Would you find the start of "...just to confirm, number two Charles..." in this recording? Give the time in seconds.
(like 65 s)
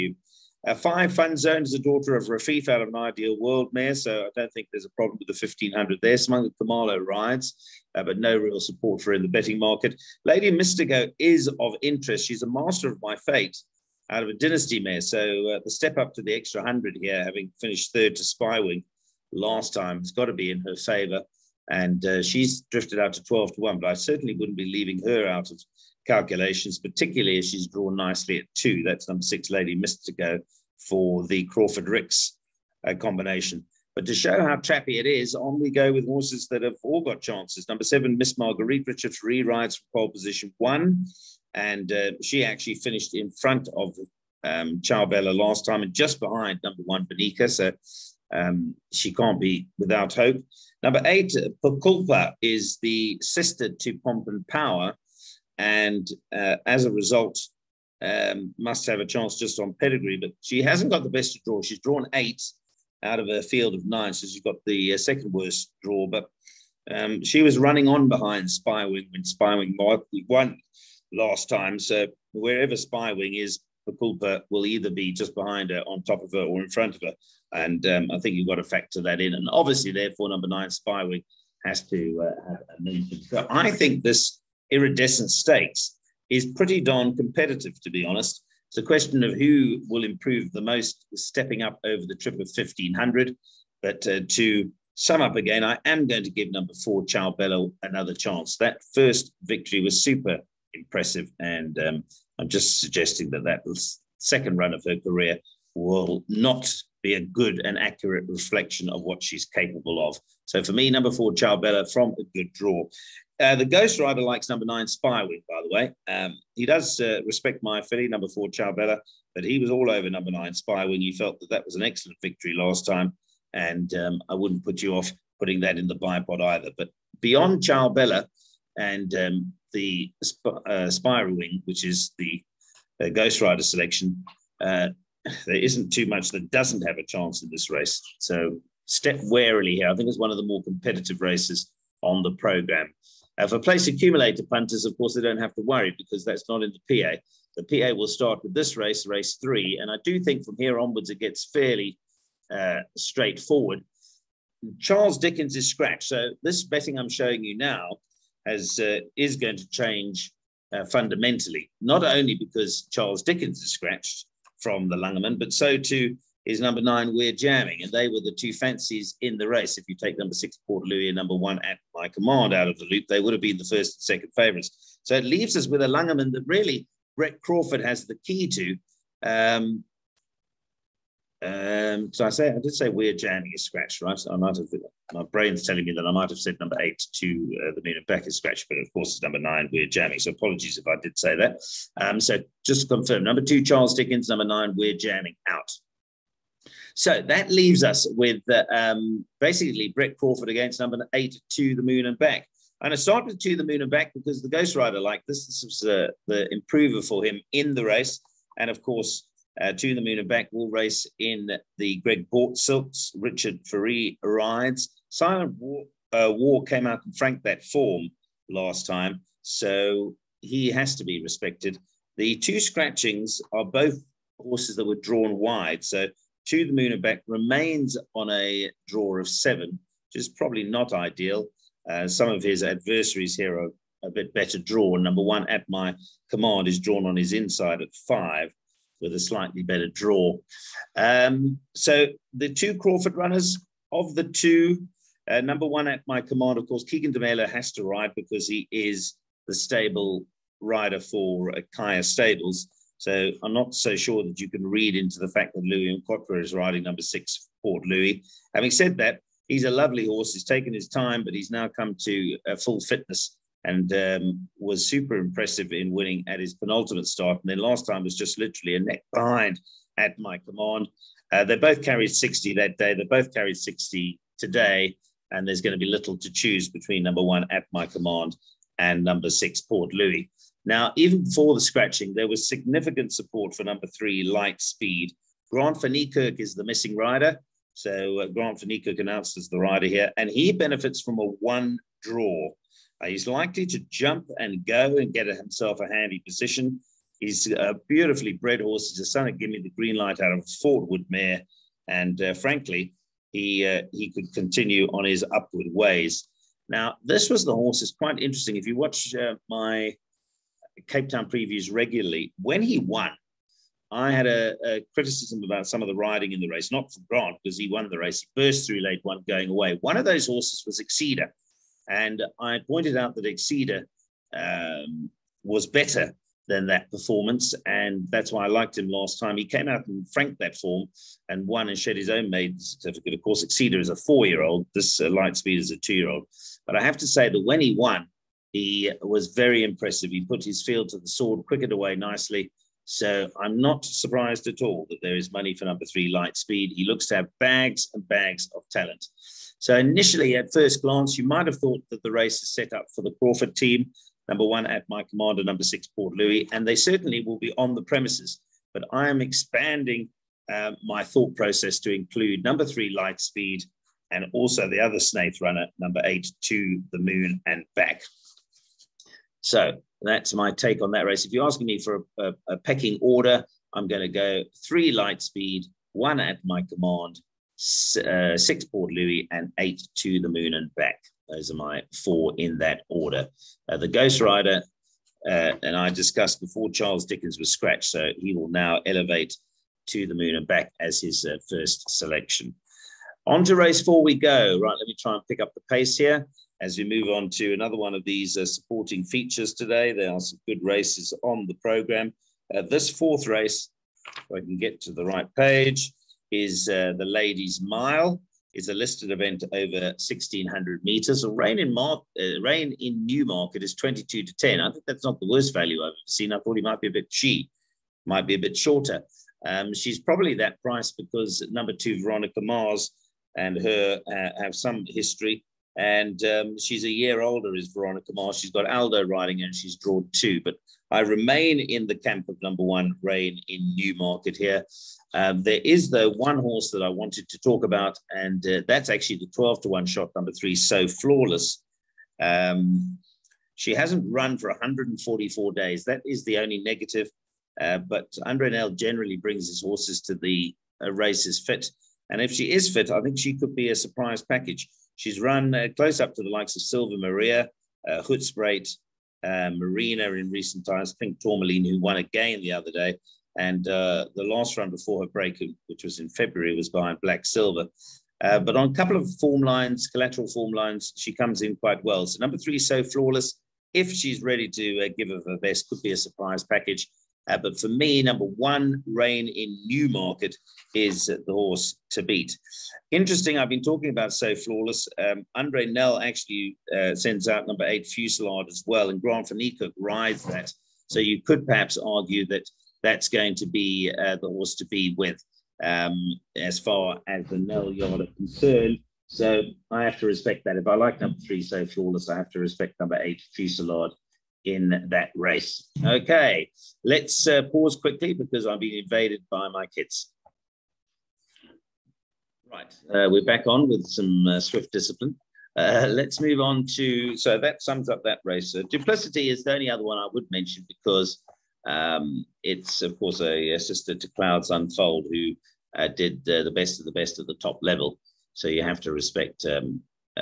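192 s.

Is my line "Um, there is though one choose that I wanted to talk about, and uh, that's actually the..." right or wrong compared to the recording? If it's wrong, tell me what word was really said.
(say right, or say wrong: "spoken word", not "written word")
wrong: "horse", not "choose".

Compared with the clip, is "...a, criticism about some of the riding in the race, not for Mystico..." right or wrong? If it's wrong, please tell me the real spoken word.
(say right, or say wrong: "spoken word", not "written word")
wrong: "Grant", not "Mystico".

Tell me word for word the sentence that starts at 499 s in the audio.
So I have to respect that.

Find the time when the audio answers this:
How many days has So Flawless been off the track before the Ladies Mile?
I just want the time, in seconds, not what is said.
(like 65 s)
444 s.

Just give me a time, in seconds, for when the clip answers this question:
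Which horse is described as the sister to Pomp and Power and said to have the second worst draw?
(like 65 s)
51 s.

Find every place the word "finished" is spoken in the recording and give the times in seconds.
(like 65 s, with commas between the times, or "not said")
17 s, 42 s.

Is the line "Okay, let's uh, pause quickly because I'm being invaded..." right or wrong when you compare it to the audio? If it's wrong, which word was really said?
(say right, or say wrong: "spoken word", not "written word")
right.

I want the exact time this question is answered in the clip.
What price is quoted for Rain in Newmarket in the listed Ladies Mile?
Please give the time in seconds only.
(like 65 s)
413 s.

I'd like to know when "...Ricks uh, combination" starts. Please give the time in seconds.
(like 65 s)
31 s.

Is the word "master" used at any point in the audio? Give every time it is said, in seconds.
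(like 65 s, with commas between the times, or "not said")
12 s.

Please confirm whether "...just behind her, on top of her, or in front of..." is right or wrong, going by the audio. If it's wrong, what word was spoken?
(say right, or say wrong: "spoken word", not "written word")
right.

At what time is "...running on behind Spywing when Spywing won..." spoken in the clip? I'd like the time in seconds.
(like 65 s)
67 s.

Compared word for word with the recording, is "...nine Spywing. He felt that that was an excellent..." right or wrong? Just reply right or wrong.
right.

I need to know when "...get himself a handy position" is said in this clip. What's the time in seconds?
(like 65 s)
295 s.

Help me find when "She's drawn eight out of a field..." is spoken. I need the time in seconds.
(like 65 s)
61 s.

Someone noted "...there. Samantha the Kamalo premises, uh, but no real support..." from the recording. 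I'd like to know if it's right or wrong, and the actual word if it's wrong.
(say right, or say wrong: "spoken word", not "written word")
wrong: "rides", not "premises".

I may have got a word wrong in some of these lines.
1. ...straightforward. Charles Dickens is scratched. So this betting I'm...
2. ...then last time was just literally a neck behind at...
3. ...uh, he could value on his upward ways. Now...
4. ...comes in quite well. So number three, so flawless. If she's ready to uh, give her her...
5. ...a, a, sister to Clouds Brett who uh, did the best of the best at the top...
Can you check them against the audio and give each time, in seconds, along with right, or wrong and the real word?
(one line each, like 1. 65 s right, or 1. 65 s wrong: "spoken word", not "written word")
1. 152 s right
2. 267 s right
3. 303 s wrong: "continue", not "value"
4. 471 s right
5. 523 s wrong: "Unfold", not "Brett".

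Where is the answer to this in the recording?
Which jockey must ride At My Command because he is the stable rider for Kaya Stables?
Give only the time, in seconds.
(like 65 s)
246 s.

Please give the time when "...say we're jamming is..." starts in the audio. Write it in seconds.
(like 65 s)
182 s.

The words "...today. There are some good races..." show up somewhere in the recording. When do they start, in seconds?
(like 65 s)
399 s.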